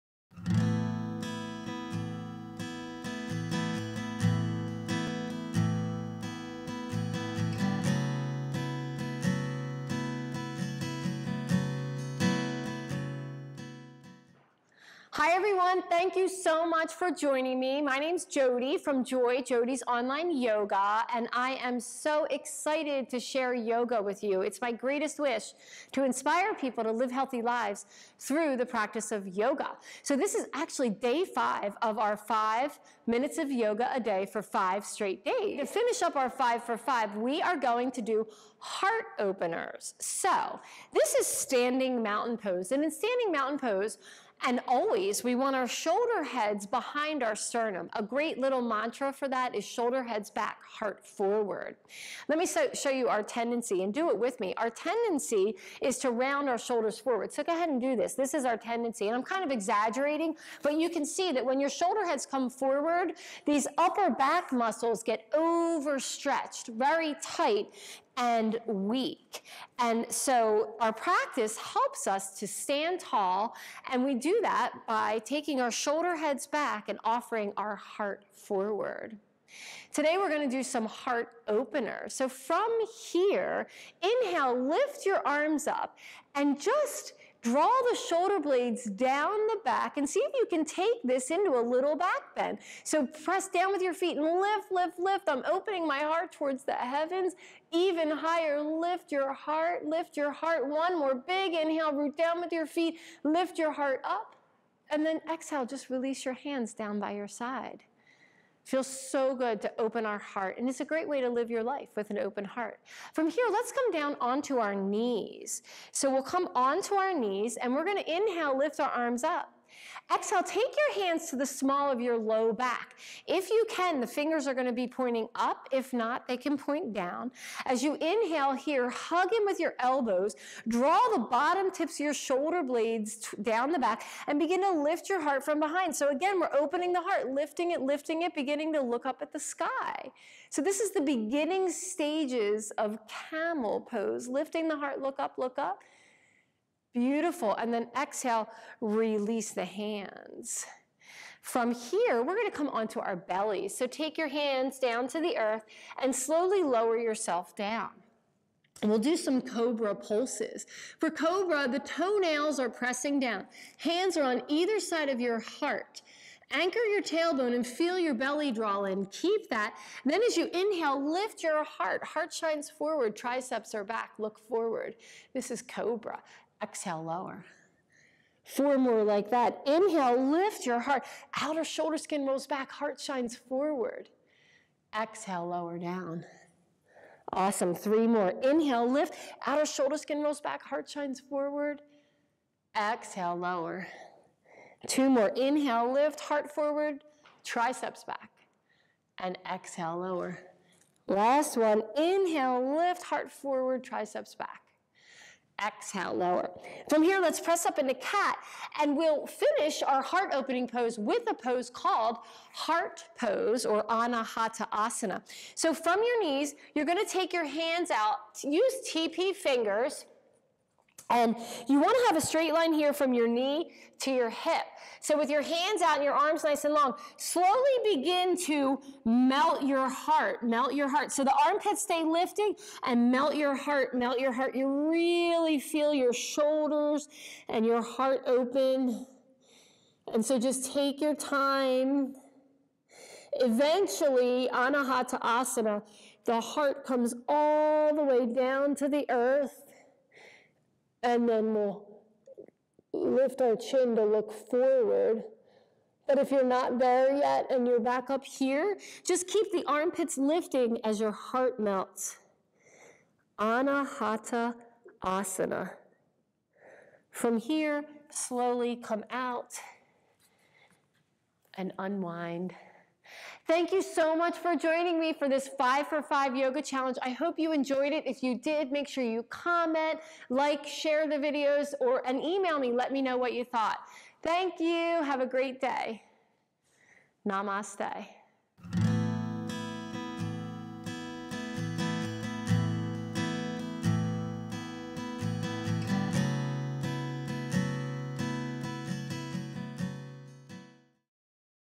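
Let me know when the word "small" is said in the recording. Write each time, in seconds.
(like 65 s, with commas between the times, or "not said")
121 s.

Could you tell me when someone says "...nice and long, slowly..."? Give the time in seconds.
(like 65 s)
226 s.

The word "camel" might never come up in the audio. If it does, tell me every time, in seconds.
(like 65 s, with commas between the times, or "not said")
143 s.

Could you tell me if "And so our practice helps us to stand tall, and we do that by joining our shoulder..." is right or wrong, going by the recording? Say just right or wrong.
wrong.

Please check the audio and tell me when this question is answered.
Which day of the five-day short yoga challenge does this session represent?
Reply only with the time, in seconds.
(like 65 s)
30 s.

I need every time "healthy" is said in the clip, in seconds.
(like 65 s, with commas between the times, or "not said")
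27 s.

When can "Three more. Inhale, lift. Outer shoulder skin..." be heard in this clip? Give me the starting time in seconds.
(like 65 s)
187 s.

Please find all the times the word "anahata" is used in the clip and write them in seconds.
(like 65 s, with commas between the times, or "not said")
213 s, 244 s, 263 s.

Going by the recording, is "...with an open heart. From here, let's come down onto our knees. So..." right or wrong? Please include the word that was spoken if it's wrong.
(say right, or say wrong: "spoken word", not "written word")
right.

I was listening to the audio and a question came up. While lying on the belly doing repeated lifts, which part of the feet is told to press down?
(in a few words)
The toenails.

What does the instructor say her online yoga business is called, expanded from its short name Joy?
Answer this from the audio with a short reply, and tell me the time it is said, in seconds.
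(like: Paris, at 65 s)
Jodi's Online Yoga, at 19 s.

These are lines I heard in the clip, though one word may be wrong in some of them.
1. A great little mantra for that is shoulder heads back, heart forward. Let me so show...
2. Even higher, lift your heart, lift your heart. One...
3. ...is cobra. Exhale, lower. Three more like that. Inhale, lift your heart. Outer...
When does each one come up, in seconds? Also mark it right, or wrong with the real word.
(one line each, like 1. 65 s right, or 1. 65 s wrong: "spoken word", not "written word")
1. 47 s right
2. 97 s right
3. 175 s wrong: "Four", not "Three".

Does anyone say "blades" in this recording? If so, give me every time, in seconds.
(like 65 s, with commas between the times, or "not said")
88 s, 132 s.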